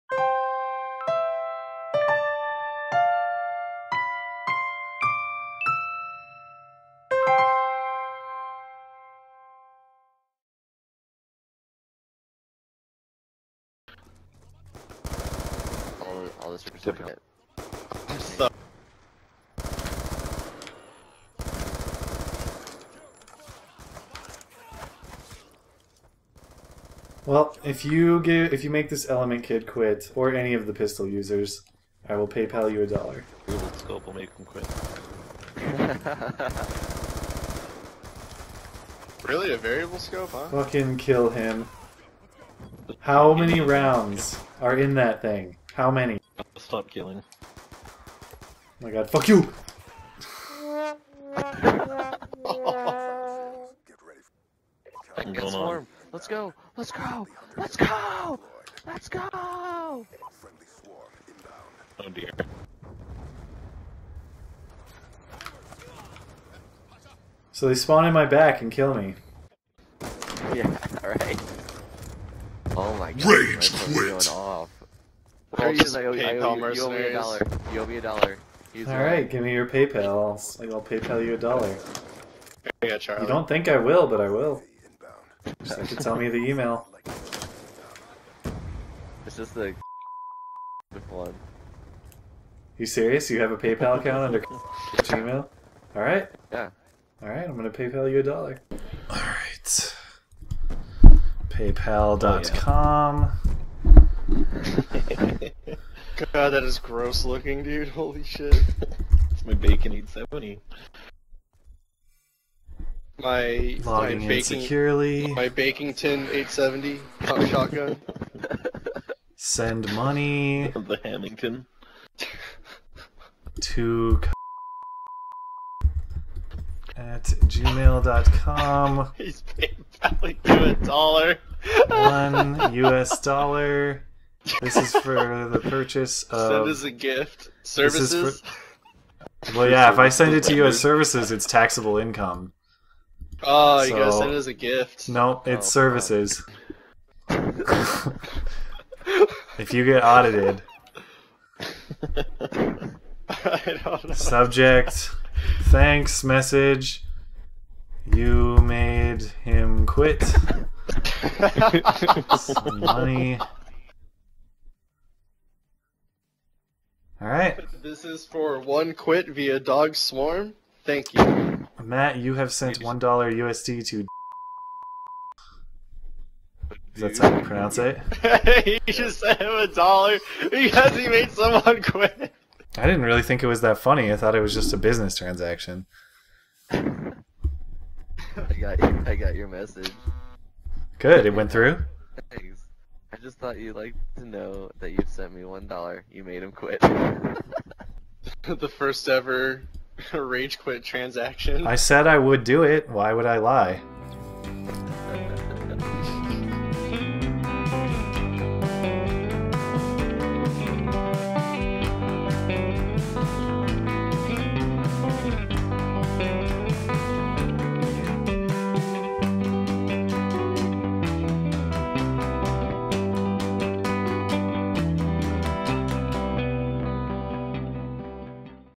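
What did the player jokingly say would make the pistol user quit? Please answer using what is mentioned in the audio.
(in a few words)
Google scope.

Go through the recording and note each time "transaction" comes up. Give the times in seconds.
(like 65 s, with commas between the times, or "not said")
185 s, 200 s.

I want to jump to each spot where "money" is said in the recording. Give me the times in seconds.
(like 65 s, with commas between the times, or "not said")
119 s, 162 s.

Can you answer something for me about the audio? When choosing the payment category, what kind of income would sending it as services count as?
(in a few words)
Taxable income.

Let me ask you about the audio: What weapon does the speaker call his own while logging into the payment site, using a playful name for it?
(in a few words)
Bakington 870 shotgun.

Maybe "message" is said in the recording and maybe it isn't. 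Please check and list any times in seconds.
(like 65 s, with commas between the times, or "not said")
156 s, 189 s.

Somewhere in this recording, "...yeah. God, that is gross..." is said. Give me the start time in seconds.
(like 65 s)
103 s.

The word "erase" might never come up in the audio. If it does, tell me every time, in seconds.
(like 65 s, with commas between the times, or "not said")
not said.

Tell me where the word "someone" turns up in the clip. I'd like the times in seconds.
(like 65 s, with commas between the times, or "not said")
181 s.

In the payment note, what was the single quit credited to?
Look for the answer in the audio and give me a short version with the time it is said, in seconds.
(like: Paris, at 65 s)
Dog Swarm, at 169 s.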